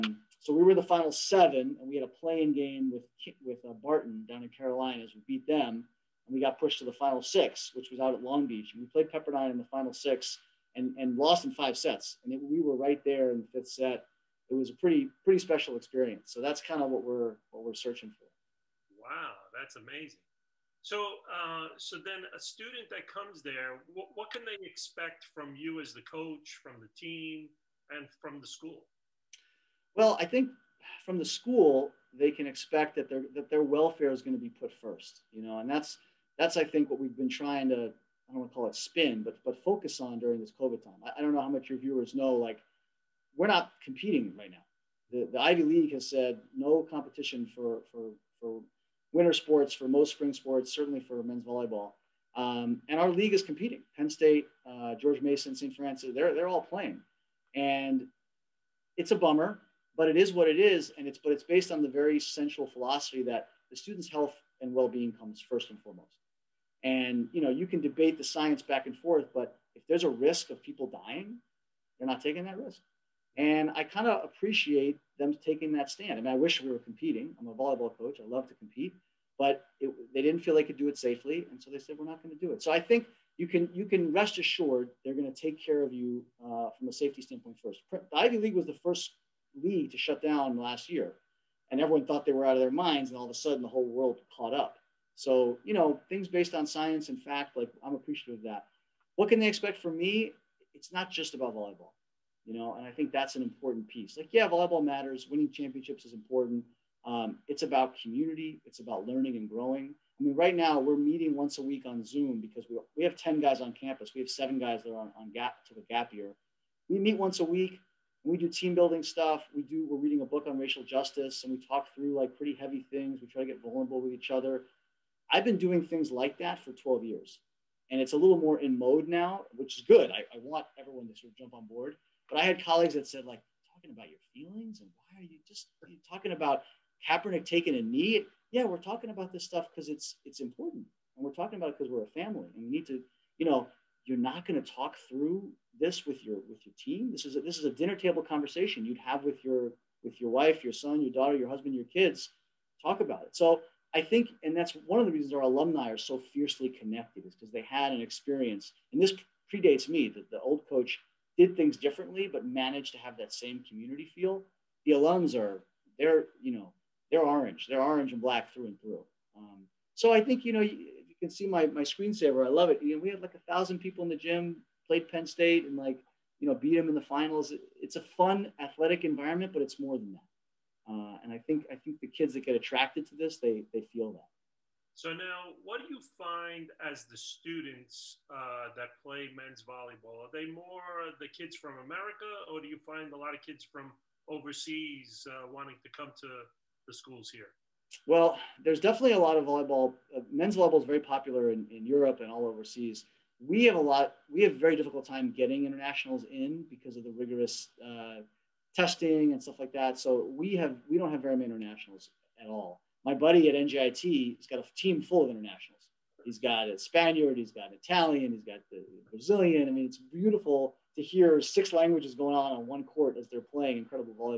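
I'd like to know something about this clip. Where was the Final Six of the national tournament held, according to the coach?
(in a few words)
Long Beach.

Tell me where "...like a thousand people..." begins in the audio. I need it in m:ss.
2:53.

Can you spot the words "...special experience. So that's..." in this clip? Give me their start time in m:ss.
0:15.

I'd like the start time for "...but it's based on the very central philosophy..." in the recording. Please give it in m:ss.
1:01.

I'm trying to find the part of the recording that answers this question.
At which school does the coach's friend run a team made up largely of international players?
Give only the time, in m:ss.
3:33.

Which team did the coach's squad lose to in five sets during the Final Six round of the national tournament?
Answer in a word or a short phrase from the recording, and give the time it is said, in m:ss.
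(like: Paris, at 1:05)
Pepperdine, at 0:09.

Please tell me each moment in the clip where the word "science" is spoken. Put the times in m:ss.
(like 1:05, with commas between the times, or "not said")
1:08, 1:36.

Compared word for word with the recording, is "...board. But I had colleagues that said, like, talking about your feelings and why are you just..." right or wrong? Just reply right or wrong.
right.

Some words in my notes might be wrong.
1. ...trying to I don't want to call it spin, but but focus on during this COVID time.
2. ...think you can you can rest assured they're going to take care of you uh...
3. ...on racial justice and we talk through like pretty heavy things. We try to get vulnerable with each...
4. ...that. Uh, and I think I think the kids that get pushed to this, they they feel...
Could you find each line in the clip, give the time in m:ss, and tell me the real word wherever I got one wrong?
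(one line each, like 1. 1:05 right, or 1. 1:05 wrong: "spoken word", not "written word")
1. 0:37 right
2. 1:22 right
3. 2:00 right
4. 3:00 wrong: "attracted", not "pushed".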